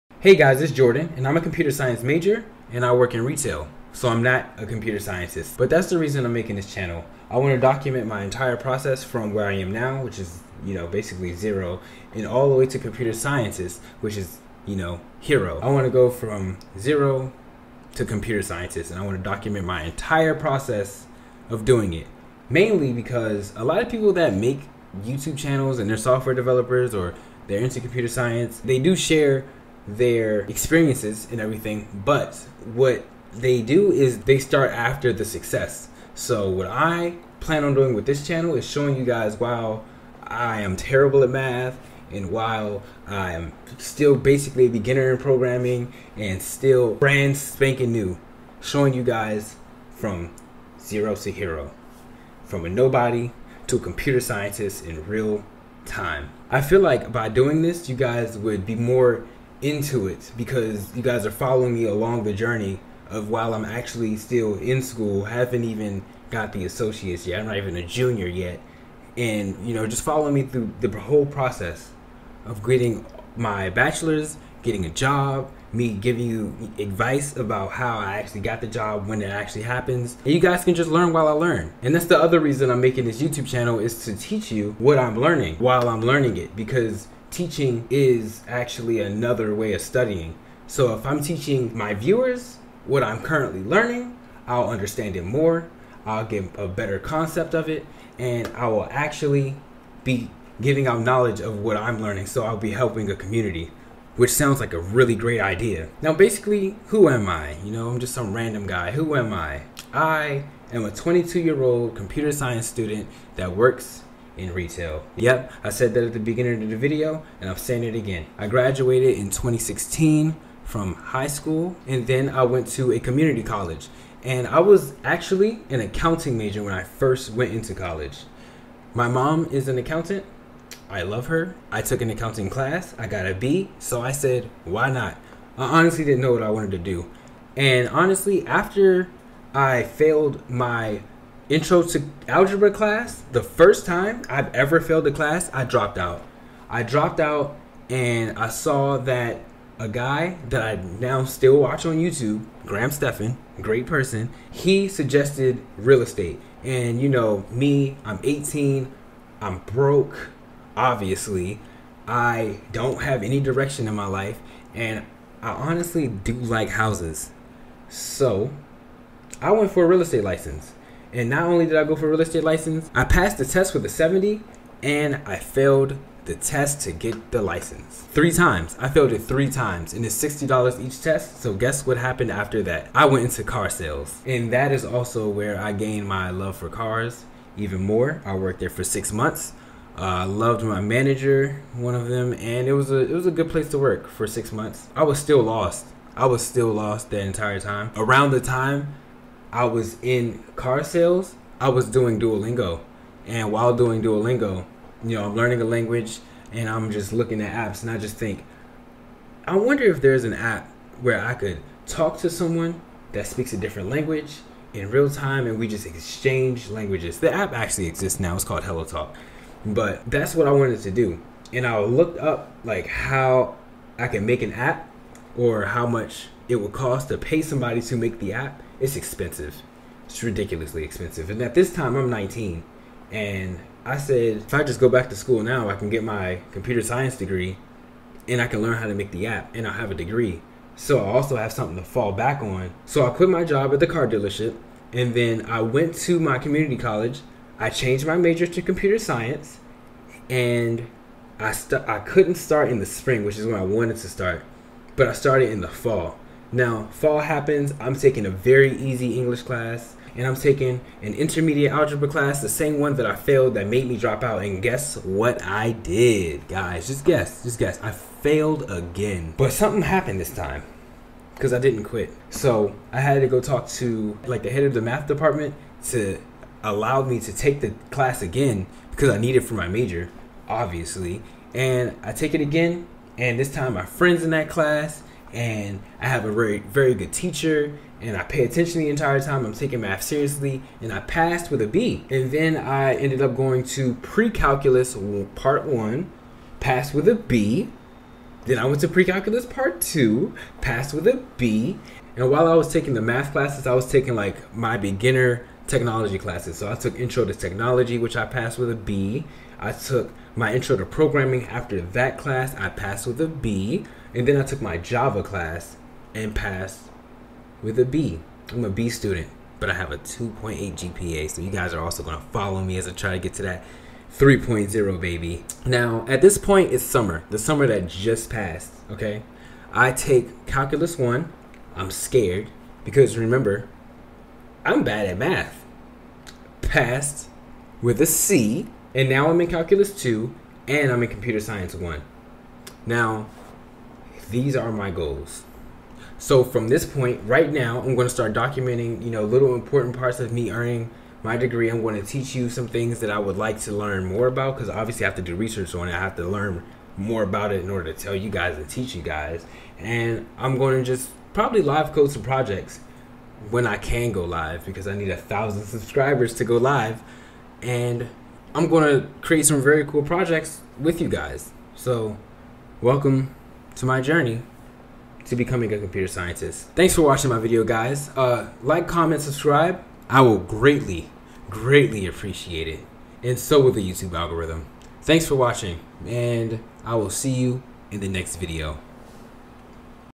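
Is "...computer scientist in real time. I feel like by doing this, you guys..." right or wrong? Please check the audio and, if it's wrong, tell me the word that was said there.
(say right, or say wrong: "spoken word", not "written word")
right.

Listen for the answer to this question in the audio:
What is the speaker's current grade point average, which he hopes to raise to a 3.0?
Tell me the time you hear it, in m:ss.
5:19.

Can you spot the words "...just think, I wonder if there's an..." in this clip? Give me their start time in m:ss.
3:27.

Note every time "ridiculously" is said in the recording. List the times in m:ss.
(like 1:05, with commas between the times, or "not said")
3:50.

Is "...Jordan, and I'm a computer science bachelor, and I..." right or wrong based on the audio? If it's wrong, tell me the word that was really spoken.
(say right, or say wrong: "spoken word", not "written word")
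wrong: "major", not "bachelor".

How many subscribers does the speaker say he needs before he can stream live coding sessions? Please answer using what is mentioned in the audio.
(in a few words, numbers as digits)
1000.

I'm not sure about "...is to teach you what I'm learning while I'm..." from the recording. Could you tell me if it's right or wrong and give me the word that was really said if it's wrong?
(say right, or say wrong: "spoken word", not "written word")
right.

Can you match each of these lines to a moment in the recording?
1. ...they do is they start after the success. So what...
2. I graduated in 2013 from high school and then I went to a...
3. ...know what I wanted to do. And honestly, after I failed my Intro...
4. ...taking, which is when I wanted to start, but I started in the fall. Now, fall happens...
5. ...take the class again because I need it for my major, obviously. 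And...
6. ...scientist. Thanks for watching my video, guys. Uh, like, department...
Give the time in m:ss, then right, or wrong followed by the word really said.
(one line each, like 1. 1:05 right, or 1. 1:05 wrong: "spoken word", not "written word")
1. 0:33 right
2. 1:58 wrong: "2016", not "2013"
3. 2:16 right
4. 4:12 wrong: "spring", not "taking"
5. 4:37 right
6. 6:16 wrong: "comment", not "department".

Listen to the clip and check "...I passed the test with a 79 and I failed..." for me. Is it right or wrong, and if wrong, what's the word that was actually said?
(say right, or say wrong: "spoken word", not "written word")
wrong: "70", not "79".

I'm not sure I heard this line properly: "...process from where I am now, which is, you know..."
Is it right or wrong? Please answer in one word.
right.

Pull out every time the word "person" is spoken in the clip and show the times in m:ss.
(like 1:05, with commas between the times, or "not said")
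2:33.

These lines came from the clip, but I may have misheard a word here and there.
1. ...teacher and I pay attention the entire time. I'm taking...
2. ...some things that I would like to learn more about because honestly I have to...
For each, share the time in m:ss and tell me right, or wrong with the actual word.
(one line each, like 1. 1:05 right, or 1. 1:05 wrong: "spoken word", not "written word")
1. 4:47 right
2. 5:52 wrong: "obviously", not "honestly".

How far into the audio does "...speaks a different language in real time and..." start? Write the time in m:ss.
3:33.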